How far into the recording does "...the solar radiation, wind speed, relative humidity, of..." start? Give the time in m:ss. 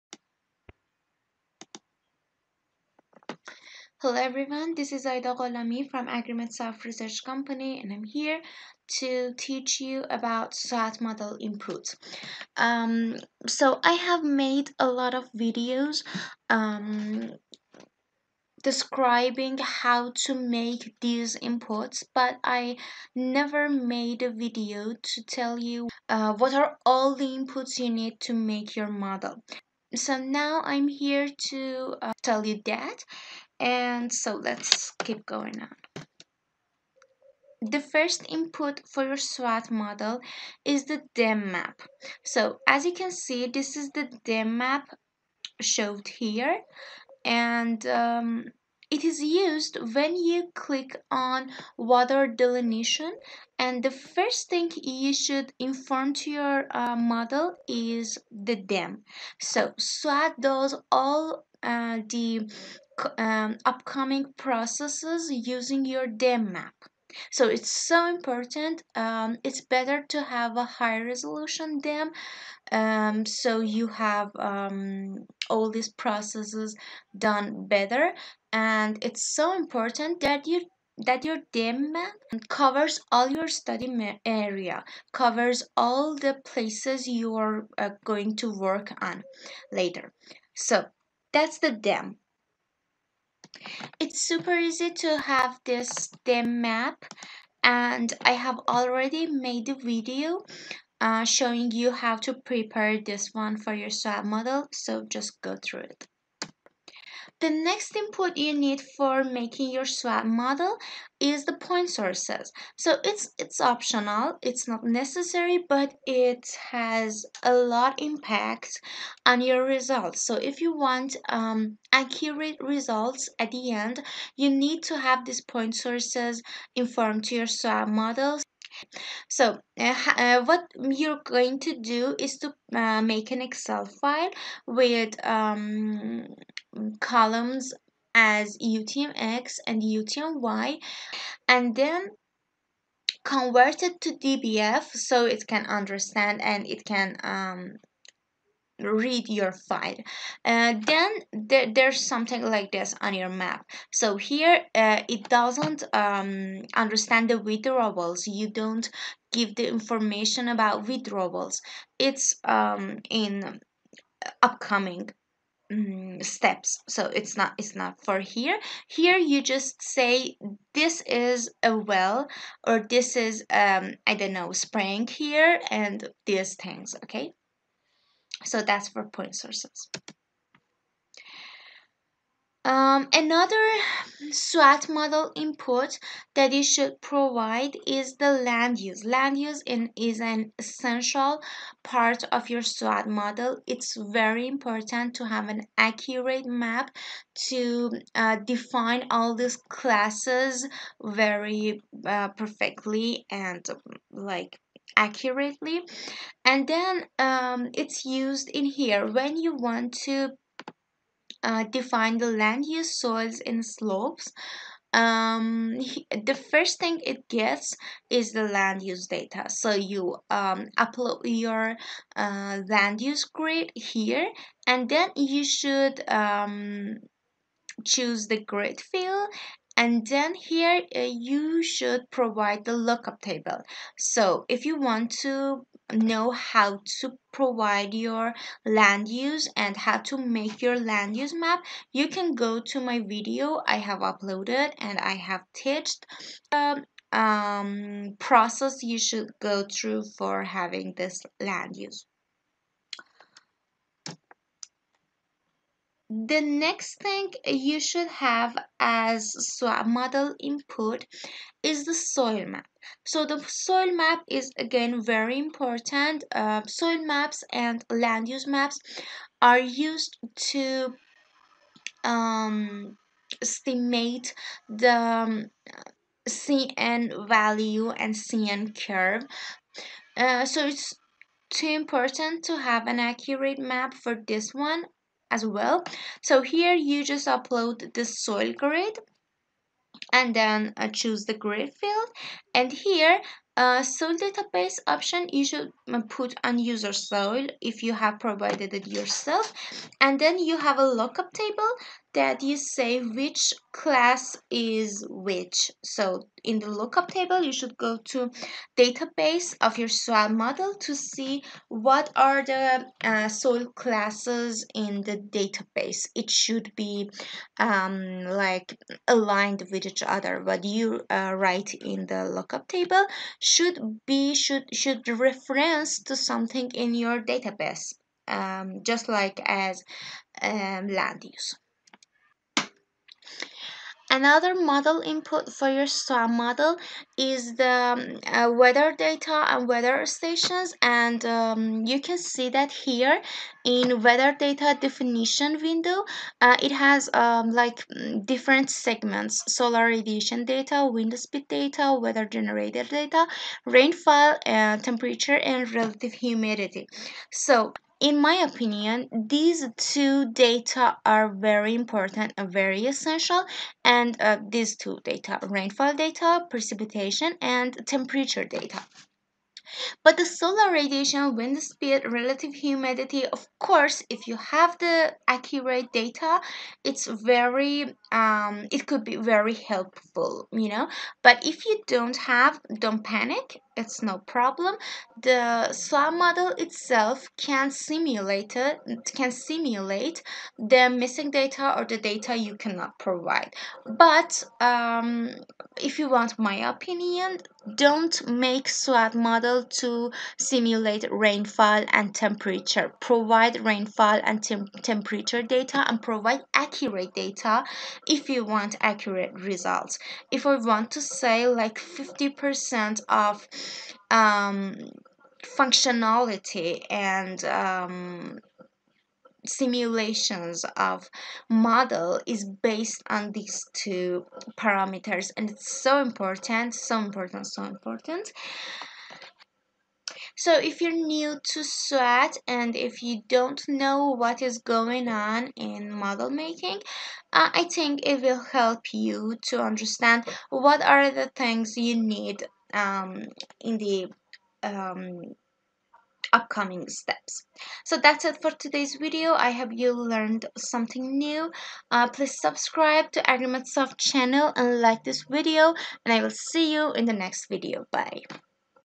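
6:10.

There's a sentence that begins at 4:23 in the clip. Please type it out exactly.
So the soil map is again very important.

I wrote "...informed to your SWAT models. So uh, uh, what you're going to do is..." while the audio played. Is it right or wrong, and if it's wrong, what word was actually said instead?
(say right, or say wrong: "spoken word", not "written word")
right.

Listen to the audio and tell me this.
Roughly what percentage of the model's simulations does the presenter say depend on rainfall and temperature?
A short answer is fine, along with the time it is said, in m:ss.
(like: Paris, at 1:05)
50%, at 6:51.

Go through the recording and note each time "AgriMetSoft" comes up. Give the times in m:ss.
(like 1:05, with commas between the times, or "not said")
0:06, 7:33.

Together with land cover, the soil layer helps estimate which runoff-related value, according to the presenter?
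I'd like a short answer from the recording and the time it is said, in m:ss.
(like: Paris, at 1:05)
CN value, at 4:36.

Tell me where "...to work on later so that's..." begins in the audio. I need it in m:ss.
1:28.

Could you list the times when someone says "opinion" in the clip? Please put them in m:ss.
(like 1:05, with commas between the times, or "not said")
5:58, 6:36.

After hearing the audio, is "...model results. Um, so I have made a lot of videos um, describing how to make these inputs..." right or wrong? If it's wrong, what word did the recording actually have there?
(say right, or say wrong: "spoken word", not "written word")
wrong: "inputs", not "results".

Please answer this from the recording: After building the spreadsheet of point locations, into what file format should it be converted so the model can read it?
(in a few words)
DBF.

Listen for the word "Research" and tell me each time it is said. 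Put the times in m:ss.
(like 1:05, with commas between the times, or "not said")
0:06.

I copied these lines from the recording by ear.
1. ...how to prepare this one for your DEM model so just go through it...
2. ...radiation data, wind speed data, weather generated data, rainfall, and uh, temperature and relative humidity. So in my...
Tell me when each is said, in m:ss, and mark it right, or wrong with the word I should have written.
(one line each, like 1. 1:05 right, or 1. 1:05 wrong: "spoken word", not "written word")
1. 1:41 wrong: "SWAT", not "DEM"
2. 5:49 right.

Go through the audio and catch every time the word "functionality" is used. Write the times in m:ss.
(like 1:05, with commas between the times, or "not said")
6:55.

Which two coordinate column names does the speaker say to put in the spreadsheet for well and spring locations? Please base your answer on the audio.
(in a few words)
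UTM-X and UTM-Y.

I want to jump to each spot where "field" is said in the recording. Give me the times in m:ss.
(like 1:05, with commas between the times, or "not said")
3:48, 4:51.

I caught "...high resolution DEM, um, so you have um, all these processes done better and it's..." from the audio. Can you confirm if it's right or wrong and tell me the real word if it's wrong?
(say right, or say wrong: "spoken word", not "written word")
right.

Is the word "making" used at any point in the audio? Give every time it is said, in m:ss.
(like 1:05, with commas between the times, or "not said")
1:49, 7:16.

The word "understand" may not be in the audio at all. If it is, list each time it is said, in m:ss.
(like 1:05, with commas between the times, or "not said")
2:25, 2:36, 7:19.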